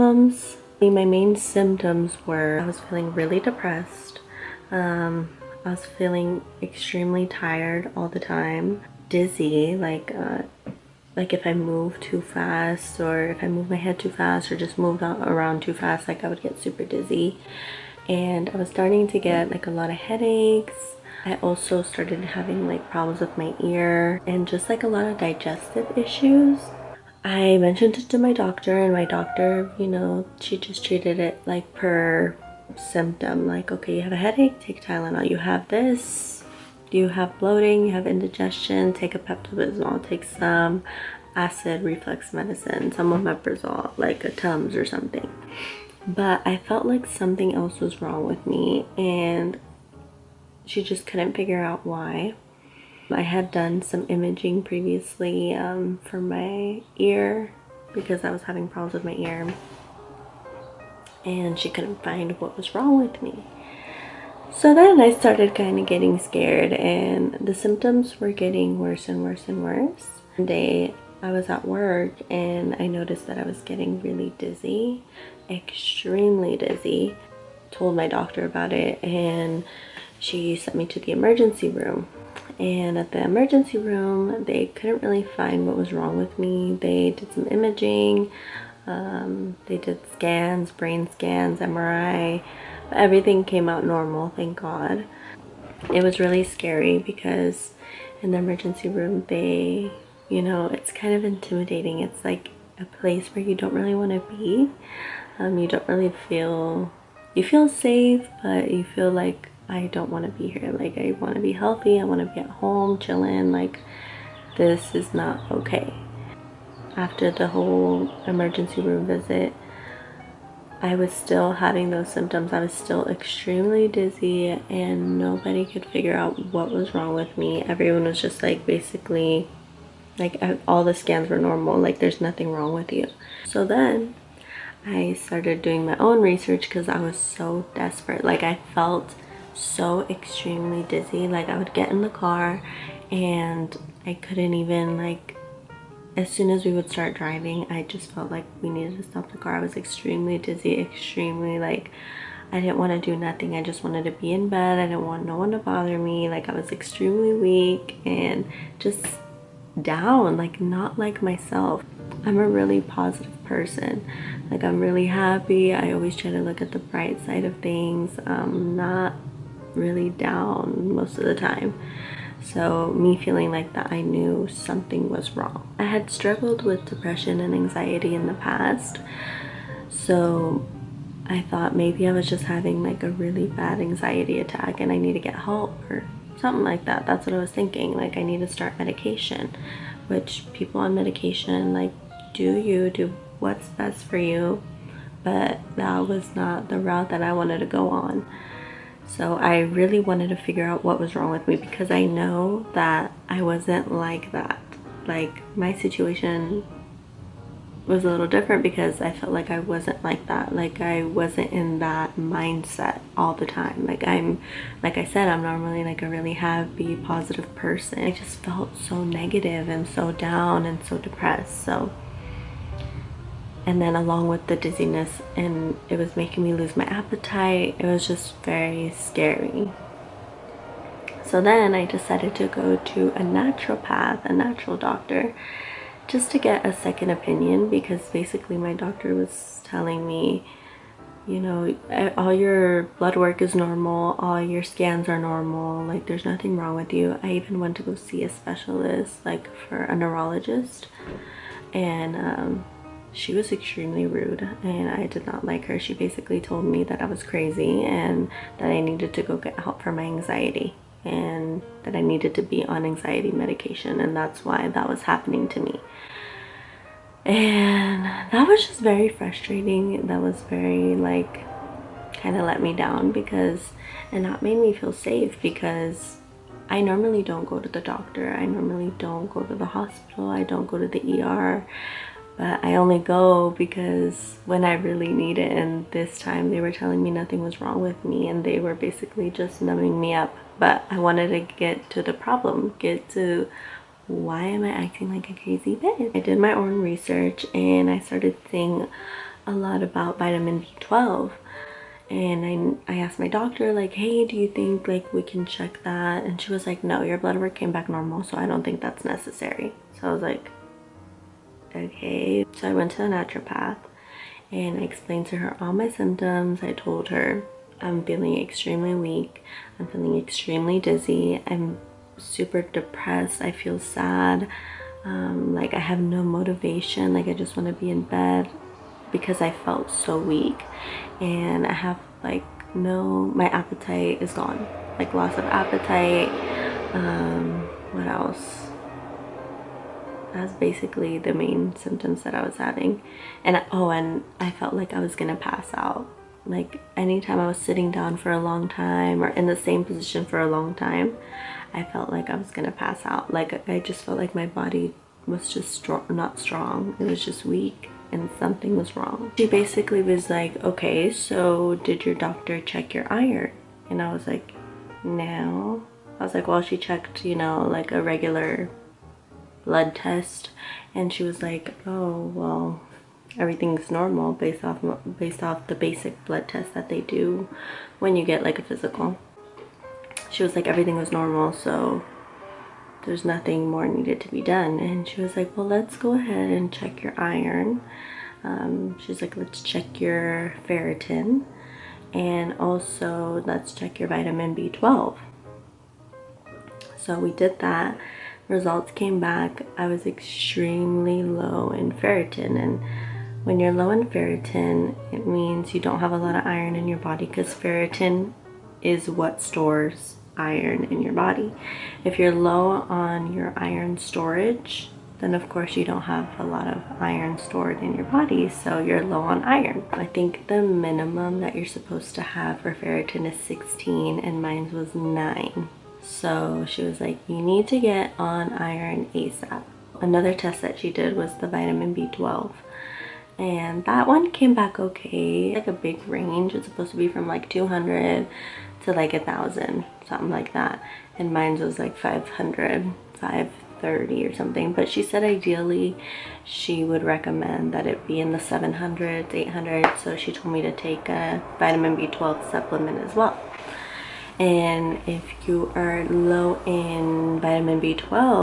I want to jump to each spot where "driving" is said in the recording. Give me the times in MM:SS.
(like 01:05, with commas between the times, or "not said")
02:27.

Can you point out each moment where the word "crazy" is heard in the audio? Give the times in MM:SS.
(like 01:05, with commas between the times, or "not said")
04:17, 04:55.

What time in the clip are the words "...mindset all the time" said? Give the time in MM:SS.
03:32.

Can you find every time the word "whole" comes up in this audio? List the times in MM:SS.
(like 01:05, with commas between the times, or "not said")
01:57.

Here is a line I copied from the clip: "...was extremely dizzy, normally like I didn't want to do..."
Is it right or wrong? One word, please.
wrong.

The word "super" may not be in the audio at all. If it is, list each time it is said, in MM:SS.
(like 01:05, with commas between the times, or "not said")
00:16, 05:22.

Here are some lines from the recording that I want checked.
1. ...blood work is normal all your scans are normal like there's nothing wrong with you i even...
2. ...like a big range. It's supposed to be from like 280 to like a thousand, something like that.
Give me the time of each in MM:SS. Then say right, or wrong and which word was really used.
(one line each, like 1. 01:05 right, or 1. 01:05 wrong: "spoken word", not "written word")
1. 04:02 right
2. 07:15 wrong: "200", not "280".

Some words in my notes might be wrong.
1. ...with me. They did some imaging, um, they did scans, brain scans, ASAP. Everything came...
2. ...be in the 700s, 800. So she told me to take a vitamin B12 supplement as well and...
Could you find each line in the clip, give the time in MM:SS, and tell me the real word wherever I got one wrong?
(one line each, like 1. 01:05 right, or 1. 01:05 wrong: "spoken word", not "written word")
1. 01:26 wrong: "MRI", not "ASAP"
2. 07:28 right.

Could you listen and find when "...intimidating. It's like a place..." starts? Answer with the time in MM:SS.
01:41.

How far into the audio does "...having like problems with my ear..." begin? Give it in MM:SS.
00:22.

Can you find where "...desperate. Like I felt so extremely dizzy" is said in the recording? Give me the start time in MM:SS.
02:17.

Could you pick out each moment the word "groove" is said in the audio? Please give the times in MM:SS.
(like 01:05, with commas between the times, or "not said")
not said.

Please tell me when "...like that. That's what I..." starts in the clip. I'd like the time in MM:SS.
03:06.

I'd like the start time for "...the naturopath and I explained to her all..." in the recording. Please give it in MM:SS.
05:12.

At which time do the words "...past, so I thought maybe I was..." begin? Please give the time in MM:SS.
02:58.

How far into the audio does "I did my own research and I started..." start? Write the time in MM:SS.
04:56.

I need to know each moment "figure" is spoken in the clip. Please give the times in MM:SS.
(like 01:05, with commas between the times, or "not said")
00:51, 02:05, 03:20.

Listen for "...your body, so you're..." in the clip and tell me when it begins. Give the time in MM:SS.
06:57.